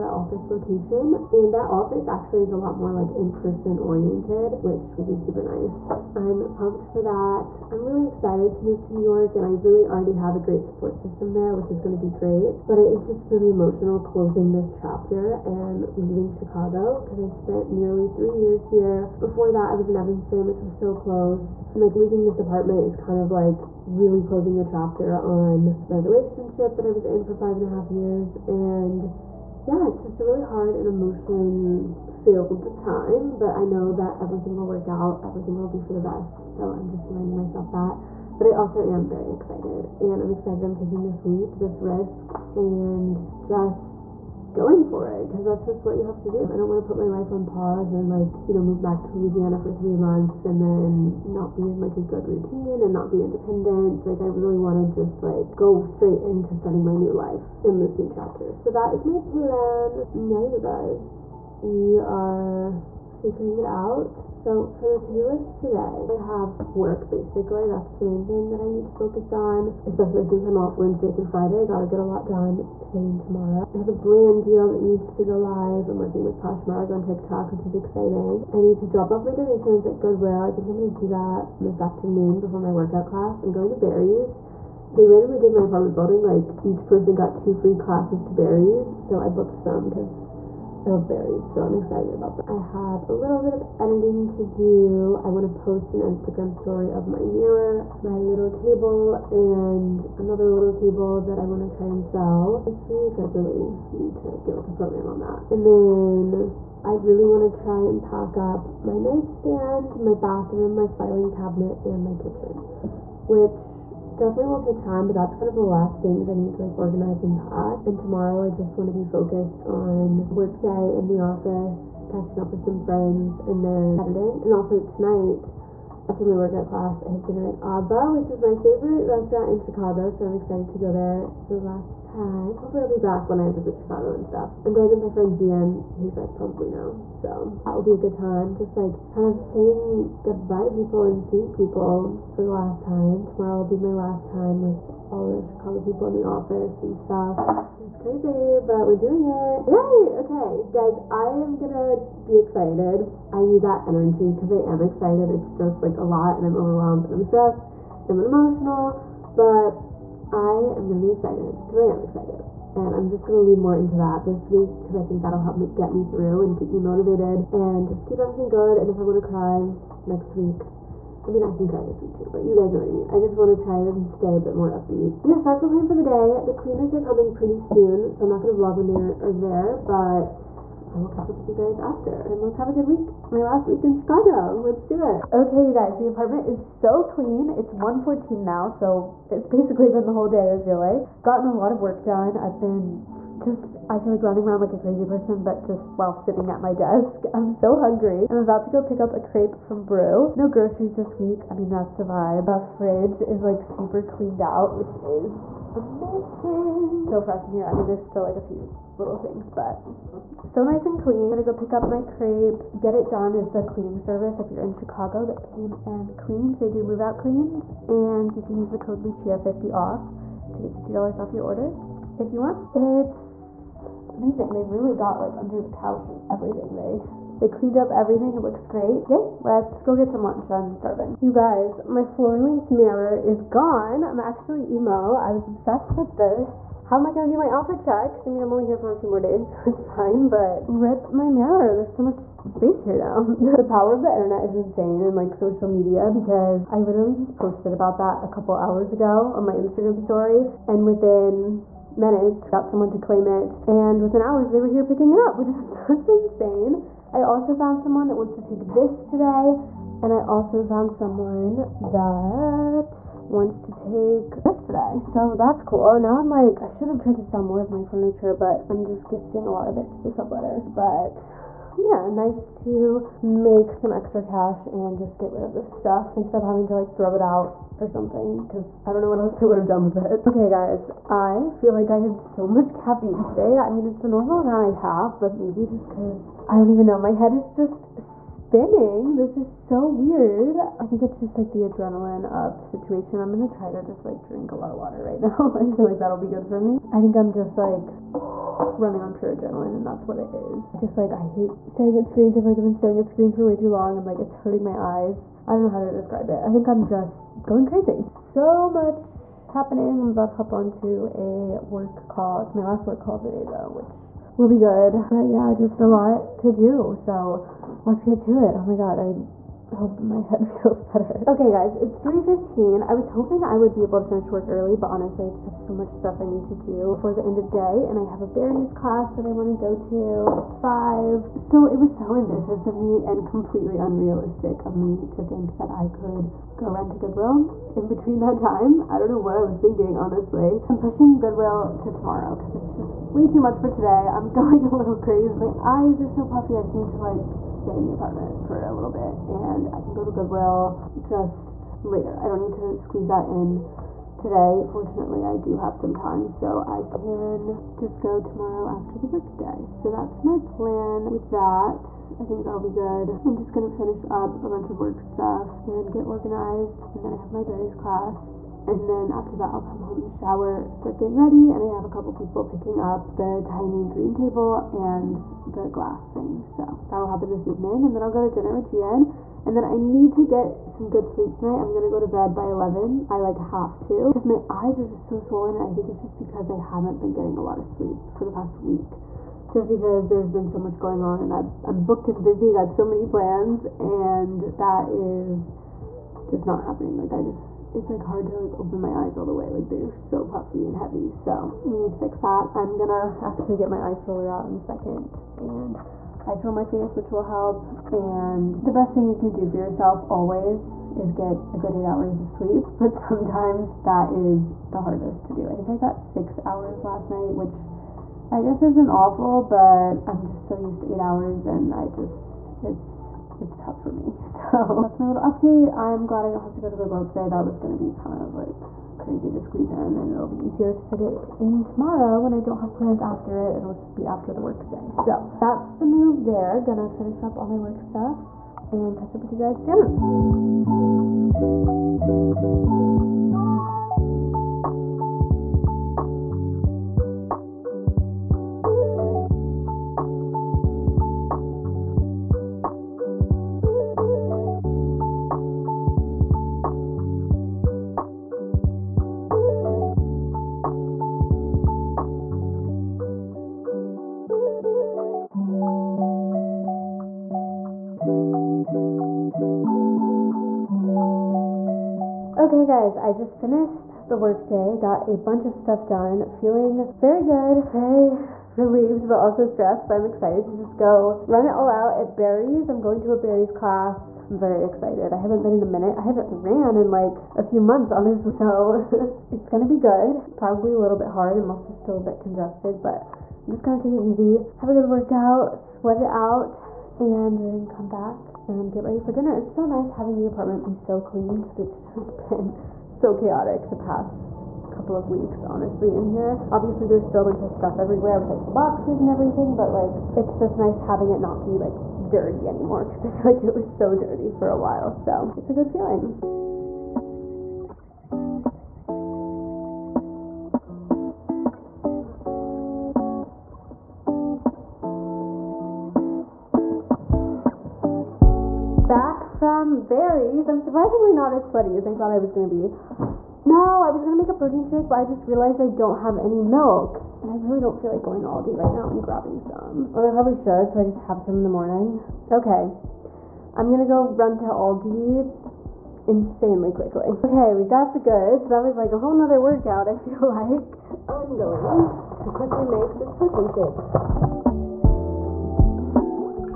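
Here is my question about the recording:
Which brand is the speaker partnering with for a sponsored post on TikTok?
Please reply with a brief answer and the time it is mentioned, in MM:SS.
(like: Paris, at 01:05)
Poshmark, at 01:16.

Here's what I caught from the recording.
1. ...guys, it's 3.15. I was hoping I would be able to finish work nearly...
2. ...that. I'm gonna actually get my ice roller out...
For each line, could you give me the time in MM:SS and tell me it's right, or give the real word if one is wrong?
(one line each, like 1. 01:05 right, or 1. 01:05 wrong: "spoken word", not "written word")
1. 05:21 wrong: "early", not "nearly"
2. 06:42 right.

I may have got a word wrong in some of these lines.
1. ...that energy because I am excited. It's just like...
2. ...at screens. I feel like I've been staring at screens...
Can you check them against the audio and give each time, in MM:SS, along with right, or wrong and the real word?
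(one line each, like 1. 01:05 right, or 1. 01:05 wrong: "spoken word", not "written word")
1. 02:33 right
2. 05:01 right.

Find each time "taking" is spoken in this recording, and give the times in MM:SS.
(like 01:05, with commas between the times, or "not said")
00:40.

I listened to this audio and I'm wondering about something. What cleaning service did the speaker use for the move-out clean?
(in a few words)
Get It Done.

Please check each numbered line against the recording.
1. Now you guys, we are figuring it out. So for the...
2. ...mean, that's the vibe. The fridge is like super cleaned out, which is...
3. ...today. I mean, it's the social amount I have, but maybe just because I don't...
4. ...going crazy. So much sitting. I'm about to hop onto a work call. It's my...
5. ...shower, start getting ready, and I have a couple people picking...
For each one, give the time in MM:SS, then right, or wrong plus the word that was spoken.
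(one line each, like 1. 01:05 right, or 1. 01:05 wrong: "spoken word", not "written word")
1. 01:00 right
2. 03:21 right
3. 04:43 wrong: "normal", not "social"
4. 05:07 wrong: "happening", not "sitting"
5. 06:10 right.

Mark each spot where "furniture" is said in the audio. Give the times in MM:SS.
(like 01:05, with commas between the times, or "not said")
04:27.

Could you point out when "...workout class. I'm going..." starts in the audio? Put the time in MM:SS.
01:22.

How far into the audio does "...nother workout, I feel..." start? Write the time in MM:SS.
09:09.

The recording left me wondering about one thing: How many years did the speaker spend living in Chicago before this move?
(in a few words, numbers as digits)
nearly 3 years.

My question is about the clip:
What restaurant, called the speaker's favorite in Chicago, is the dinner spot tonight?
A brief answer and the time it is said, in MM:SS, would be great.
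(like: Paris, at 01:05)
Aba, at 02:07.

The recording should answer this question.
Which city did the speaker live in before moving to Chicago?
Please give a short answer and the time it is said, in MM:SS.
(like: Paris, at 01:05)
Evanston, at 00:19.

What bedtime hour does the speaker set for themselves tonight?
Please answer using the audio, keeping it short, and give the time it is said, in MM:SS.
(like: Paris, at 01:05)
11, at 06:22.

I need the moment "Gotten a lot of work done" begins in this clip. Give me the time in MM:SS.
03:11.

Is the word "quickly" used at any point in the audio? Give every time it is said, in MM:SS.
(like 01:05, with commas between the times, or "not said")
09:06, 09:12.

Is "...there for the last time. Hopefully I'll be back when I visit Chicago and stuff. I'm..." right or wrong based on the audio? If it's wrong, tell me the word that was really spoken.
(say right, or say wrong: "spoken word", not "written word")
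right.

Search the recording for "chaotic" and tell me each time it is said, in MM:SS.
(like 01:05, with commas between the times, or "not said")
08:23.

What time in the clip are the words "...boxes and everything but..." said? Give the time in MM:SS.
08:28.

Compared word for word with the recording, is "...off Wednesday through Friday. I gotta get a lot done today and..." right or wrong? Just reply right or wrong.
right.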